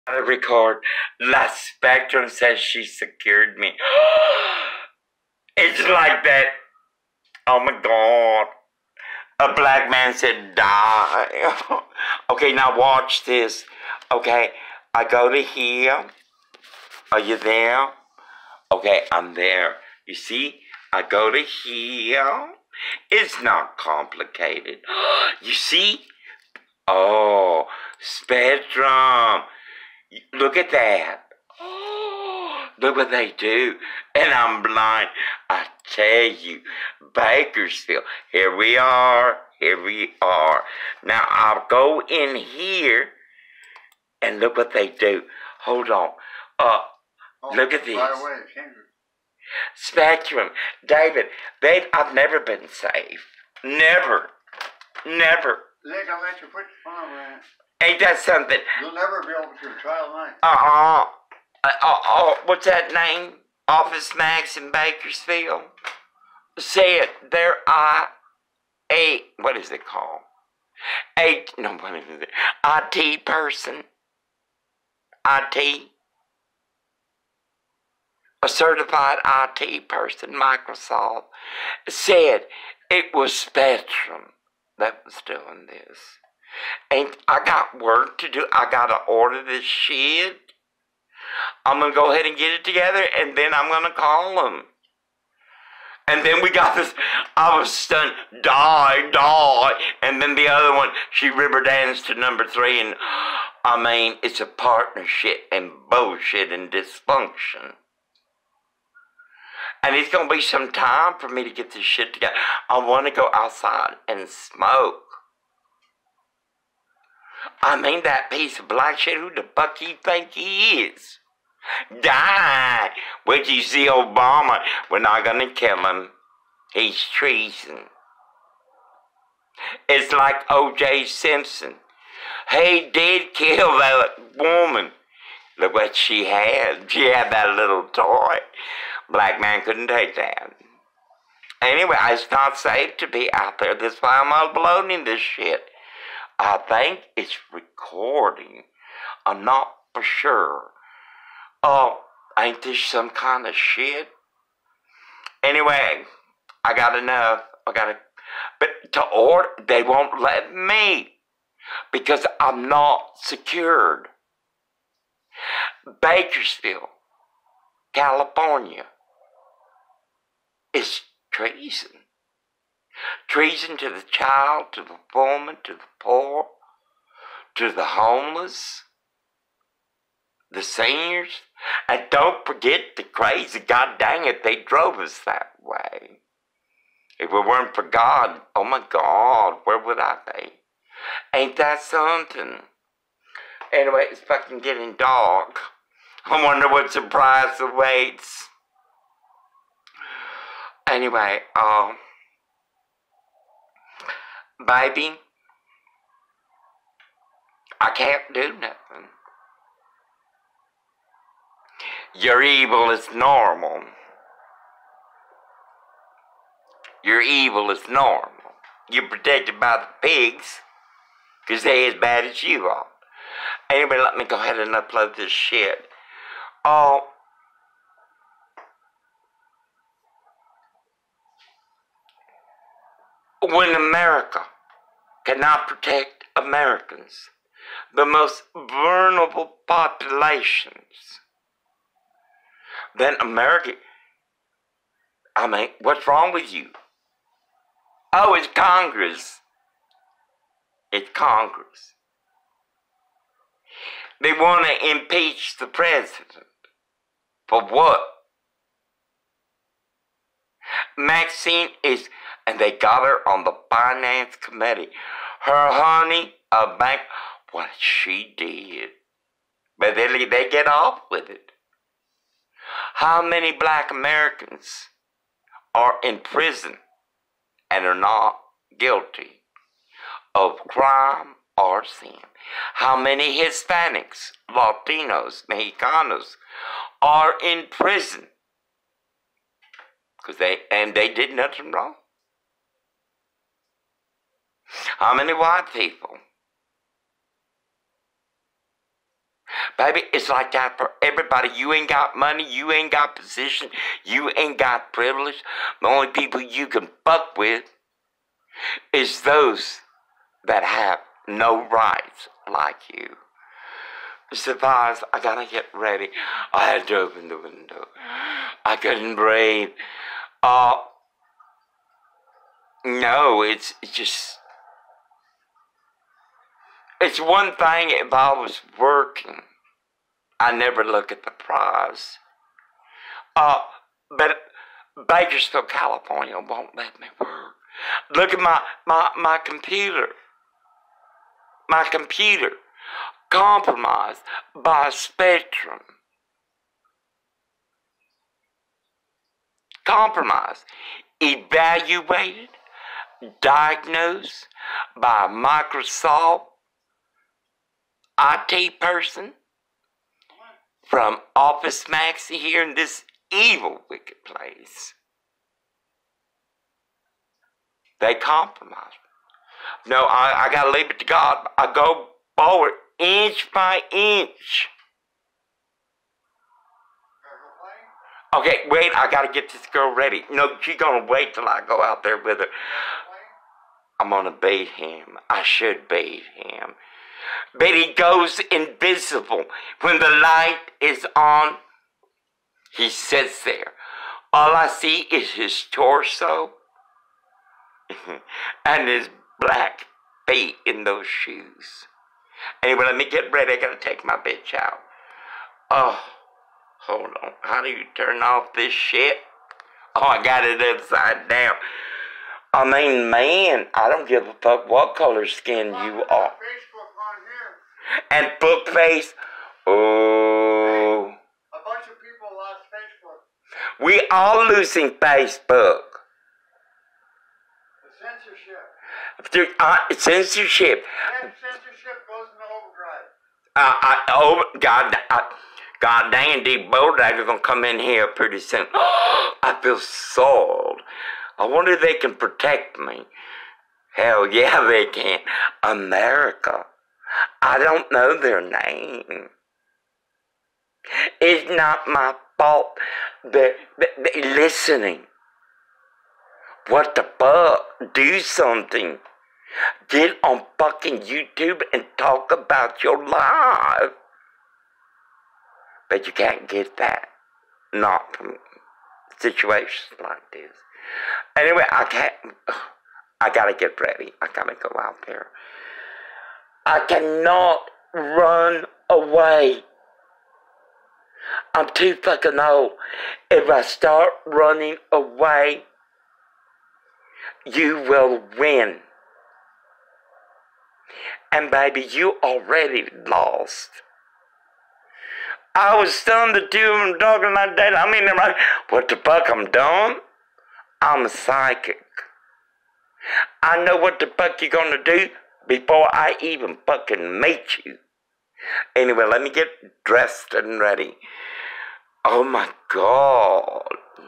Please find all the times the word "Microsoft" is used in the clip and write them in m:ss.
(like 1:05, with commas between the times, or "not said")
1:20, 5:55.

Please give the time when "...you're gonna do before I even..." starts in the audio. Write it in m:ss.
8:24.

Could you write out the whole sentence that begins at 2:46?
Bakersfield, California is treason treason to the child, to the foreman, to the poor, to the homeless, the seniors.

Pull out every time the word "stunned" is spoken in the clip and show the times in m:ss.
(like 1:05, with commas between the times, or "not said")
1:37, 8:15.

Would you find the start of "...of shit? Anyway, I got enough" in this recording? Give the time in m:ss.
2:33.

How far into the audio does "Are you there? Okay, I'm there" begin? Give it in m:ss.
0:17.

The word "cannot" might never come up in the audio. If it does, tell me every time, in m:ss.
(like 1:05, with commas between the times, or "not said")
3:55, 7:56.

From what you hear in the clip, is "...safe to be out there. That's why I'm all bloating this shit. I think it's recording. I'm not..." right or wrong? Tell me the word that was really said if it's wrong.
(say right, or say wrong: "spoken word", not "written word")
right.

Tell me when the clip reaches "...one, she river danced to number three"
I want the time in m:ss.
1:40.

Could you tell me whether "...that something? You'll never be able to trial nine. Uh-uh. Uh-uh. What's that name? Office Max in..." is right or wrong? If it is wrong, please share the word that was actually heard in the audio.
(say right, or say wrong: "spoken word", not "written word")
right.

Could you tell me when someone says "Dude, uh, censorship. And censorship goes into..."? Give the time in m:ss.
7:09.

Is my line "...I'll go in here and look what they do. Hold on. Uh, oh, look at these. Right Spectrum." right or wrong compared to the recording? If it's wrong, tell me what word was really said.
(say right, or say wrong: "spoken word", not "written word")
right.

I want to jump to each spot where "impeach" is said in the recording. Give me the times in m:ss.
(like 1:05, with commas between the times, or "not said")
4:14.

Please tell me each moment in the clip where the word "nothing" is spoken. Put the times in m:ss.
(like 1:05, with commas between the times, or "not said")
3:28, 4:51.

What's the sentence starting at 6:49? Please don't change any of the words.
Oh, I got it upside down.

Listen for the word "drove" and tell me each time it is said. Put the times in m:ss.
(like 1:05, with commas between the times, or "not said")
3:04.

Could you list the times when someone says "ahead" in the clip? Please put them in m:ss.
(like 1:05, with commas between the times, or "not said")
1:32, 3:44.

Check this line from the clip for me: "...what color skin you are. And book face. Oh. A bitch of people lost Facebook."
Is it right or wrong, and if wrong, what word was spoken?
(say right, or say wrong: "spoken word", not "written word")
wrong: "bunch", not "bitch".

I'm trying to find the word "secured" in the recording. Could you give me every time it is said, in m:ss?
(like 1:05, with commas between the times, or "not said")
0:02, 2:43.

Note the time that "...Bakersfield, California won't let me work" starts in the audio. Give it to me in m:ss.
5:35.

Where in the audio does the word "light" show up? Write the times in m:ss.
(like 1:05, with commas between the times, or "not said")
6:30.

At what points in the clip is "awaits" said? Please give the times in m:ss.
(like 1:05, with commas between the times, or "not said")
3:17.